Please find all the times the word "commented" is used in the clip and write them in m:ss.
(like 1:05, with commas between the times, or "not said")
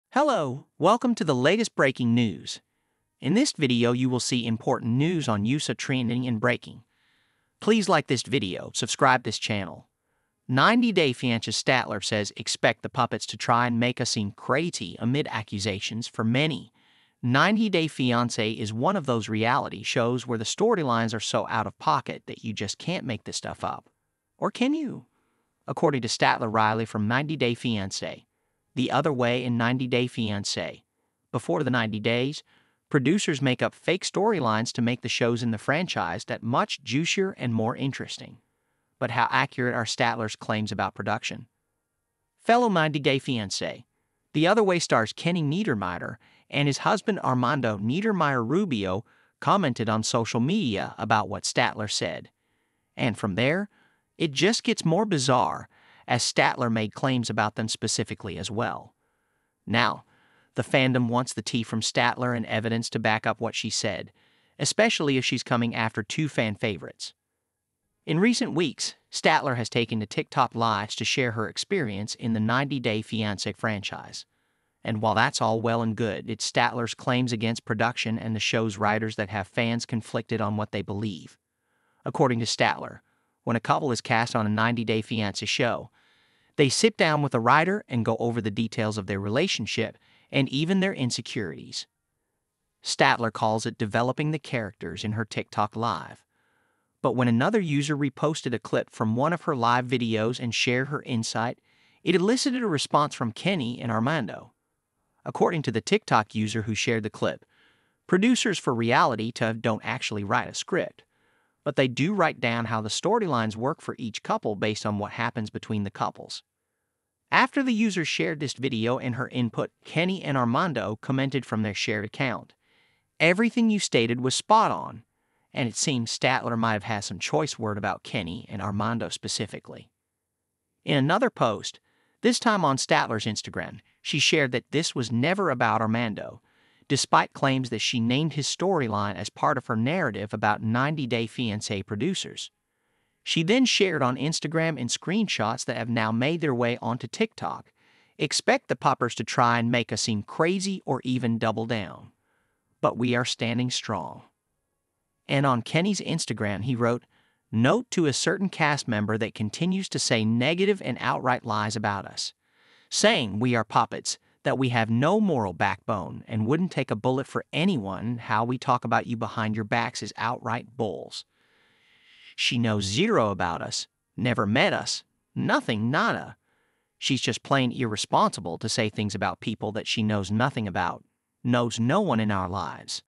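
0:49, 2:01.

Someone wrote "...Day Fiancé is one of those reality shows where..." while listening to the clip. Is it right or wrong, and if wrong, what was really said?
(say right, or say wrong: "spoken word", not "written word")
right.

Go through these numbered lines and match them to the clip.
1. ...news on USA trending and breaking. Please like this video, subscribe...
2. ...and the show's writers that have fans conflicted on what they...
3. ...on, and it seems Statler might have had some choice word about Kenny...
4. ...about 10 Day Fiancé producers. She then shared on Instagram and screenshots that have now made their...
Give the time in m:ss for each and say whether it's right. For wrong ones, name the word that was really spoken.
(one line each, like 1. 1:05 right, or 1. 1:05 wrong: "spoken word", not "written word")
1. 0:04 right
2. 1:18 right
3. 2:04 right
4. 2:20 wrong: "90", not "10".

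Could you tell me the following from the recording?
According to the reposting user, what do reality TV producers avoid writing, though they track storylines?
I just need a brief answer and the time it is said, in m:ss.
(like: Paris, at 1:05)
a script, at 1:50.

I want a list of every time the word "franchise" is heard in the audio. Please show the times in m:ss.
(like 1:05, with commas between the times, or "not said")
0:35, 1:13.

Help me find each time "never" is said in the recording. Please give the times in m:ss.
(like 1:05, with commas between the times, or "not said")
2:15, 2:54.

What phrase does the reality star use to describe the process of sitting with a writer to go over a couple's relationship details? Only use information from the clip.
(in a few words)
developing the characters.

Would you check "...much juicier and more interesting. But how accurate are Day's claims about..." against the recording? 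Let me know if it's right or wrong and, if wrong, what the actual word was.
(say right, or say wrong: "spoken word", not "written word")
wrong: "Statler", not "Day".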